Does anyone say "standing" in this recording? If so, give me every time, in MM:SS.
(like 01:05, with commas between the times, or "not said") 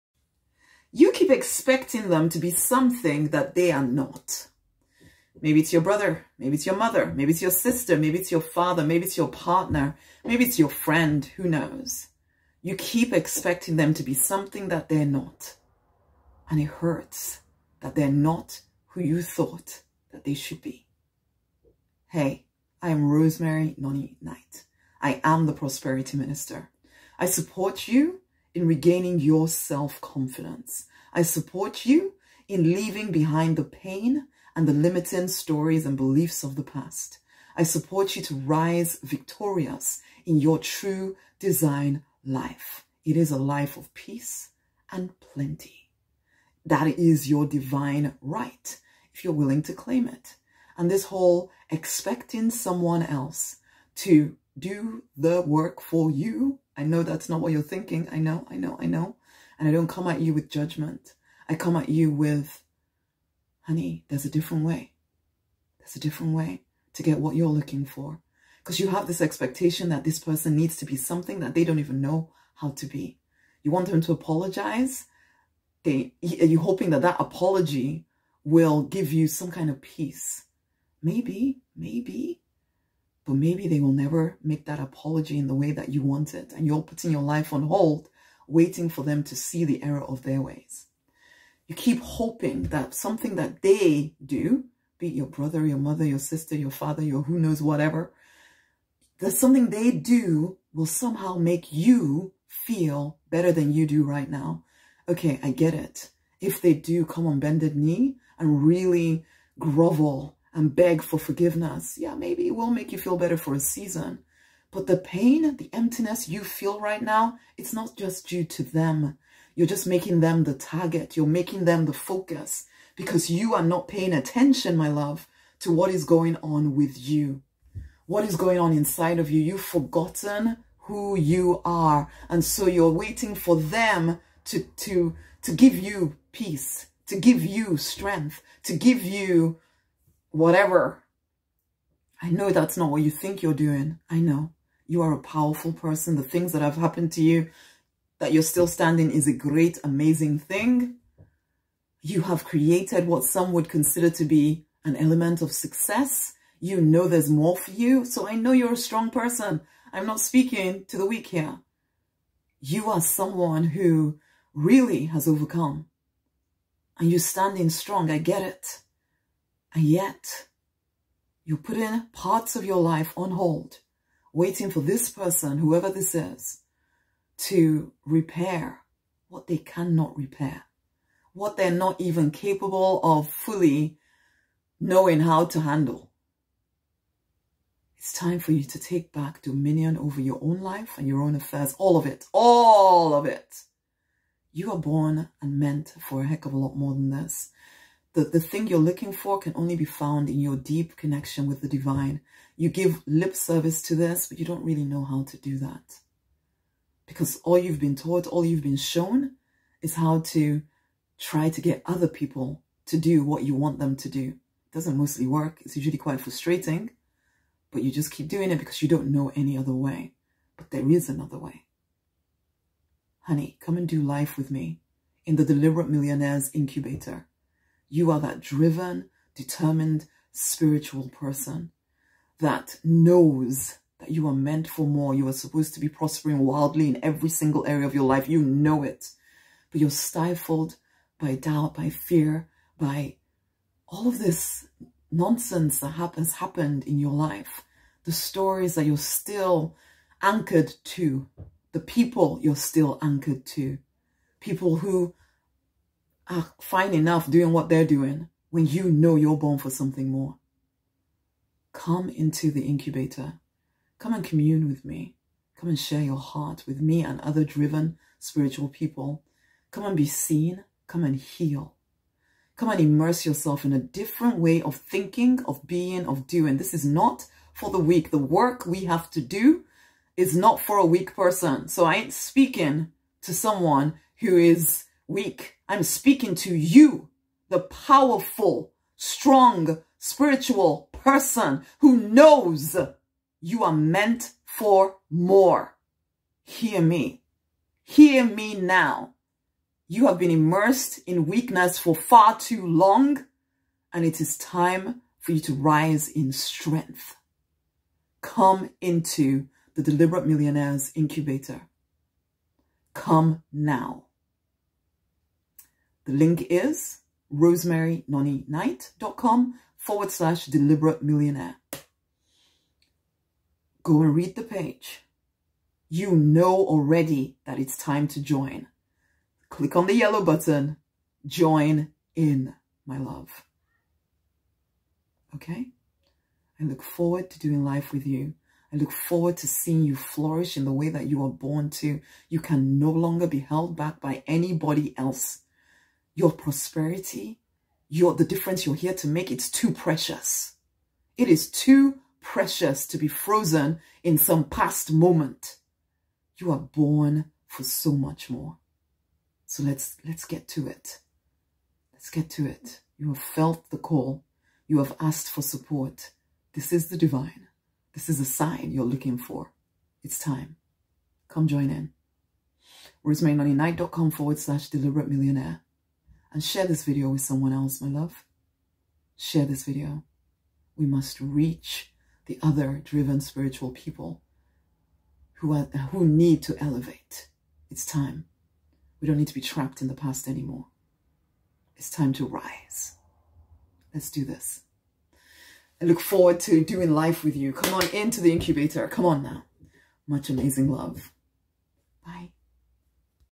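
02:28, 02:47.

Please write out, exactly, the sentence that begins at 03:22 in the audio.
You give lip service to this, but you don't really know how to do that.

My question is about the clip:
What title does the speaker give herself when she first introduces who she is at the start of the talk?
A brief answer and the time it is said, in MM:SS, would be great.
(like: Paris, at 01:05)
Prosperity Minister, at 00:25.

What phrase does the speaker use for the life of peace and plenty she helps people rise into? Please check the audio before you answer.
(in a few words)
True design life.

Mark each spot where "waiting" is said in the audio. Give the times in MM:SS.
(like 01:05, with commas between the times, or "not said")
01:28, 02:12, 02:54.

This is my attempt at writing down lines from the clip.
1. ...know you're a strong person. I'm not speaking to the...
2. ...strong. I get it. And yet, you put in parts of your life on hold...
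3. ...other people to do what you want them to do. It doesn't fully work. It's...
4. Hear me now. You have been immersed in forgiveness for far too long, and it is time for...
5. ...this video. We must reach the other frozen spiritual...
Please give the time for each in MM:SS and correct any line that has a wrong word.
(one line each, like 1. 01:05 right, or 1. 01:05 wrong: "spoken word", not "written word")
1. 02:38 right
2. 02:47 right
3. 03:31 wrong: "mostly", not "fully"
4. 04:57 wrong: "weakness", not "forgiveness"
5. 06:19 wrong: "driven", not "frozen".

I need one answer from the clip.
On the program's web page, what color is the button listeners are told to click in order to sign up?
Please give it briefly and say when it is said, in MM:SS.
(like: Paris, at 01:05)
Yellow, at 05:29.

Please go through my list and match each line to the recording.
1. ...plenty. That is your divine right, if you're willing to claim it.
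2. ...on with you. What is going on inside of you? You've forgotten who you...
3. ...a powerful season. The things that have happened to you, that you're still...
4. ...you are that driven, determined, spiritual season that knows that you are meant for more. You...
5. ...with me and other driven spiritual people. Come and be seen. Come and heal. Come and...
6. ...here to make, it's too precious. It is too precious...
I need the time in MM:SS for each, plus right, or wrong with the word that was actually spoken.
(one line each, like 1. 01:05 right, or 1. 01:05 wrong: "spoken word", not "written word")
1. 00:45 right
2. 02:06 right
3. 02:25 wrong: "person", not "season"
4. 03:47 wrong: "person", not "season"
5. 04:26 right
6. 05:48 right.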